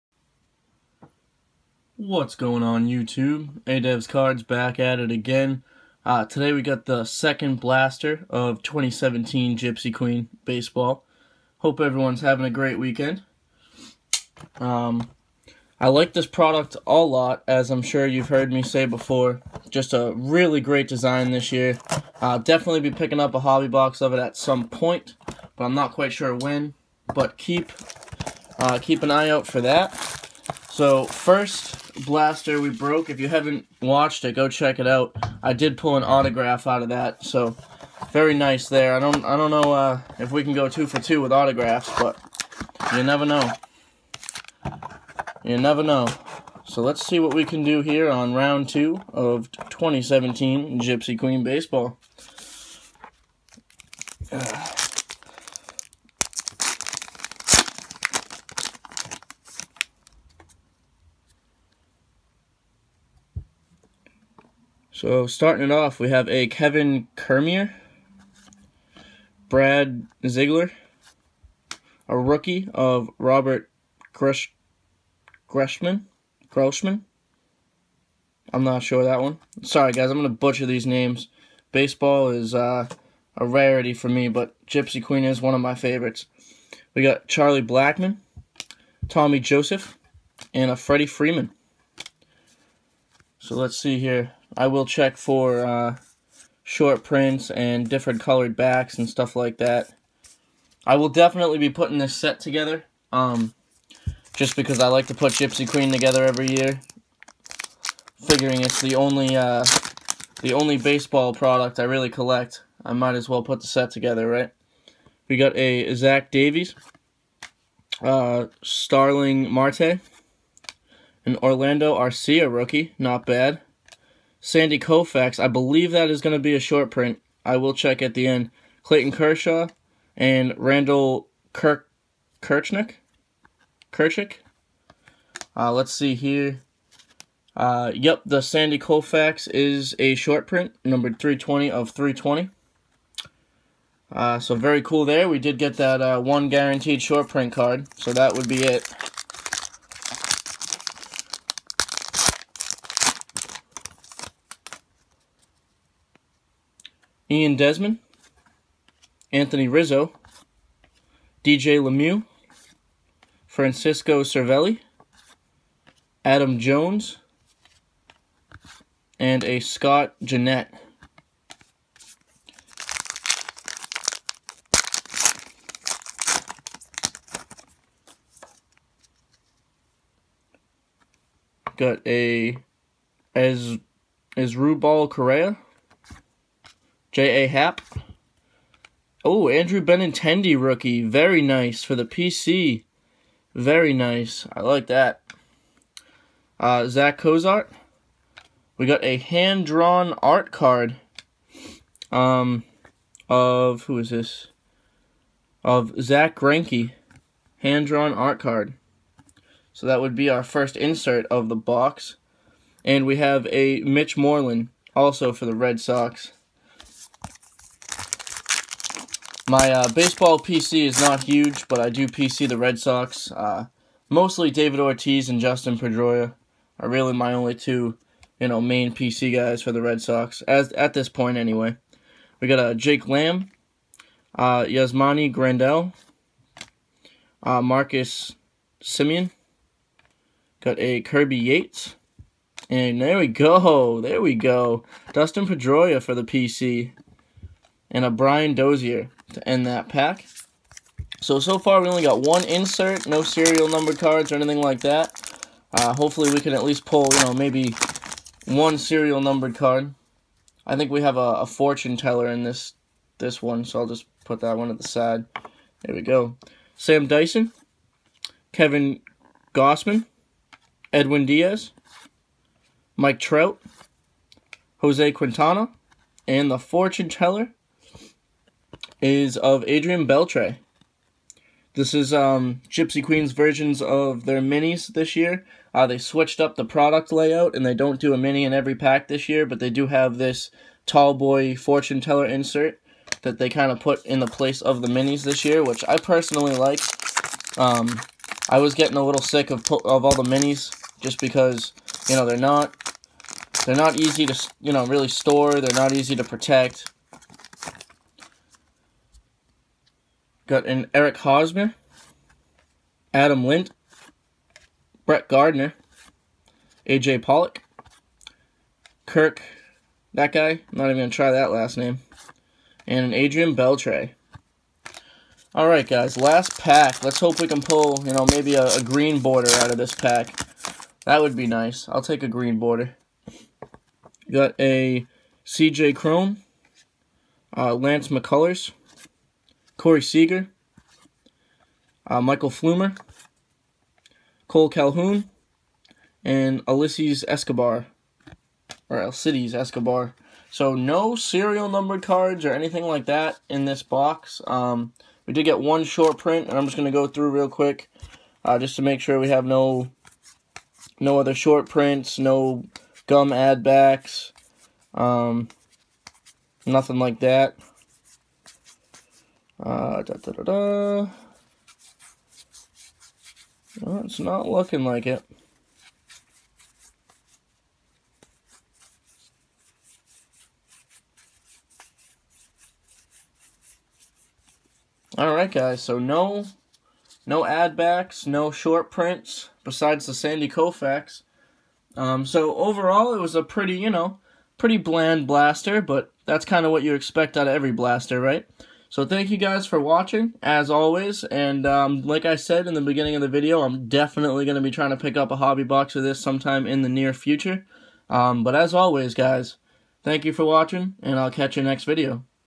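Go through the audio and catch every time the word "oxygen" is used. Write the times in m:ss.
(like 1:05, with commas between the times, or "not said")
not said.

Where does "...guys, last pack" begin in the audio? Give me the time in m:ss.
5:25.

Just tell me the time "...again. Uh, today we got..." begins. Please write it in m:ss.
0:05.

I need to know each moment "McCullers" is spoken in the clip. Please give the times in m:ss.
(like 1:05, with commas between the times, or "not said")
5:38.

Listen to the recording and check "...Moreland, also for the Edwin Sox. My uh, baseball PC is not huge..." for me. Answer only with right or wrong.
wrong.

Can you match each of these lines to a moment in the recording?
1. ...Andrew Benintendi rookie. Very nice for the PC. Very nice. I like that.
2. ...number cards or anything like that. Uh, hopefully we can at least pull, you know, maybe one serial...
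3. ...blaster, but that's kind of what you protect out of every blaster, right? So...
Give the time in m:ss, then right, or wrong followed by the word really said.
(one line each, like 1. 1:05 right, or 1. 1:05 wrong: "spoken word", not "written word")
1. 3:09 right
2. 4:13 right
3. 6:35 wrong: "expect", not "protect".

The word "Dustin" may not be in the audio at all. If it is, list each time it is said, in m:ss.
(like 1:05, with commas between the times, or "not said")
3:45, 4:05.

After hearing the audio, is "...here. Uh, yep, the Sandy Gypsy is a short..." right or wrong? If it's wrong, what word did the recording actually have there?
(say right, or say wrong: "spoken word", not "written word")
wrong: "Koufax", not "Gypsy".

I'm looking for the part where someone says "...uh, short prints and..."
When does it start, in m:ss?
1:35.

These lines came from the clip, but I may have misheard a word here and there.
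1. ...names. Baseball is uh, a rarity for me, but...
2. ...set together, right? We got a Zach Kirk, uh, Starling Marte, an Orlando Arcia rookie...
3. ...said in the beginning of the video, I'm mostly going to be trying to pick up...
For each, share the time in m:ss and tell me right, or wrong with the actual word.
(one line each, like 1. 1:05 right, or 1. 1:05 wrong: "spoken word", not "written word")
1. 1:20 right
2. 1:53 wrong: "Davies", not "Kirk"
3. 6:42 wrong: "definitely", not "mostly".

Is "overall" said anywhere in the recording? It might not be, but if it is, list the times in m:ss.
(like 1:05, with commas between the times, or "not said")
6:32.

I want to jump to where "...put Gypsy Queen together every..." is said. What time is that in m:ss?
1:45.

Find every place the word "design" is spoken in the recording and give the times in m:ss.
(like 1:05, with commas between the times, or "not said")
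0:20.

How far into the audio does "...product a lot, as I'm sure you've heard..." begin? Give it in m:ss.
0:16.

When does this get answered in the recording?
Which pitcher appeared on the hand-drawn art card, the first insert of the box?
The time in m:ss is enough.
3:26.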